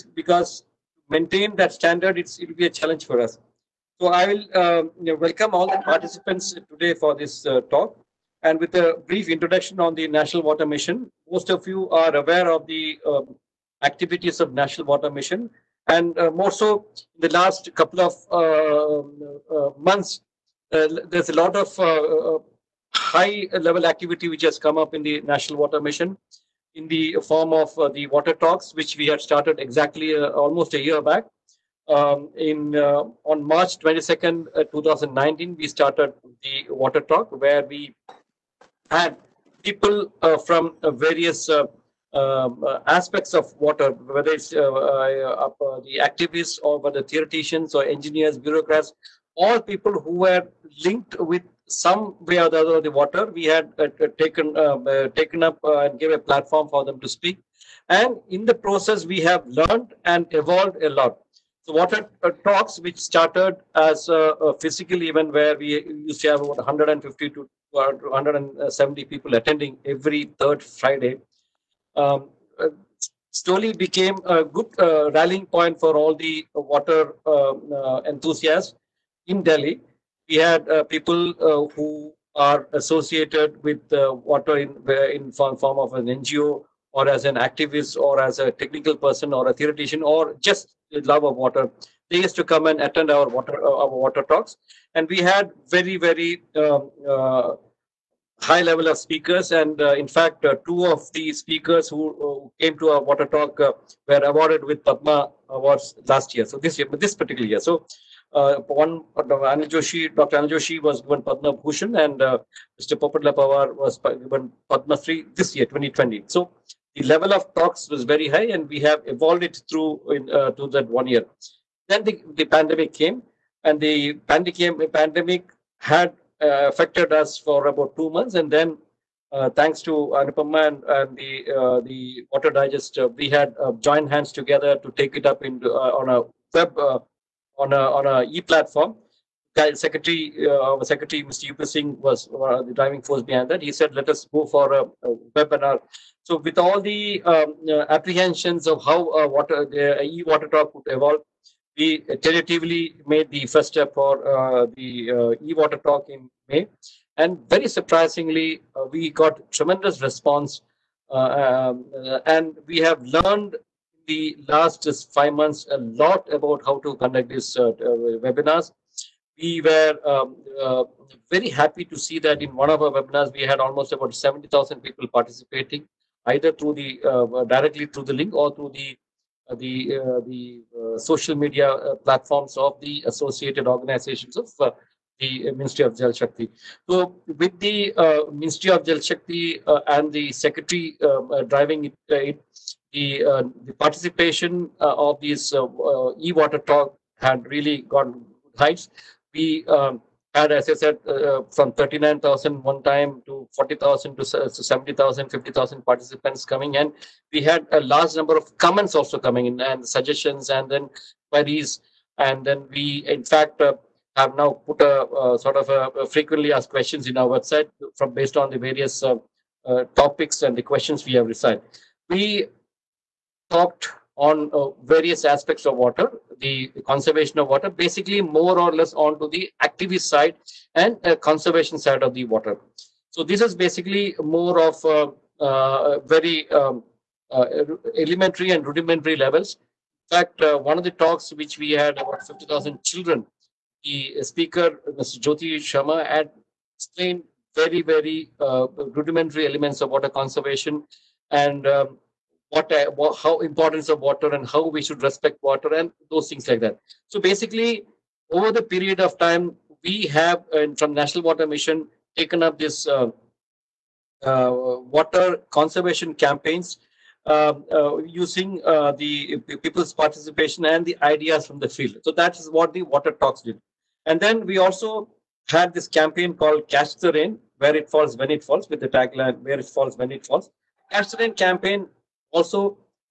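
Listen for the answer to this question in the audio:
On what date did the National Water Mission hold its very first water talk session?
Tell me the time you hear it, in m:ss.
0:33.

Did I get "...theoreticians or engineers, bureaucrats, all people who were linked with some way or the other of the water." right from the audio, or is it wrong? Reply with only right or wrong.
right.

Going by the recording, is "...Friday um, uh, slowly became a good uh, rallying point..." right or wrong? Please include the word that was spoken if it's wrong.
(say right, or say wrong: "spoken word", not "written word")
right.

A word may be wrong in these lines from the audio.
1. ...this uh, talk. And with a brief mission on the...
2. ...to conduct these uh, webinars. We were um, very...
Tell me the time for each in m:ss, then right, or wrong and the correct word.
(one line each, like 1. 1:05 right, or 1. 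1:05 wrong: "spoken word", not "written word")
1. 0:07 wrong: "introduction", not "mission"
2. 2:46 right.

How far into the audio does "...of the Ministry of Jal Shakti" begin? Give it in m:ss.
3:04.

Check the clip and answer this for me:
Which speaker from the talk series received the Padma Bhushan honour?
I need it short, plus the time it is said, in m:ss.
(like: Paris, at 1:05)
Dr. Anil Joshi, at 1:50.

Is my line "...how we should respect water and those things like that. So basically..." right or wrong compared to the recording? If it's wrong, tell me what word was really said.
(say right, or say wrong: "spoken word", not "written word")
right.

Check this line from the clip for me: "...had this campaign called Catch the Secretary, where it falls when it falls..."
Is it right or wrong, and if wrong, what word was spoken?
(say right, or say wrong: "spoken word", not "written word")
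wrong: "Rain", not "Secretary".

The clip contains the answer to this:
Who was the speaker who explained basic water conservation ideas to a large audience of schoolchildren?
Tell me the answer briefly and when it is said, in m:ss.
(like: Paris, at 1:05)
Jyoti Sharma, at 4:05.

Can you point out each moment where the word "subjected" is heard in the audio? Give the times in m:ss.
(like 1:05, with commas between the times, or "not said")
not said.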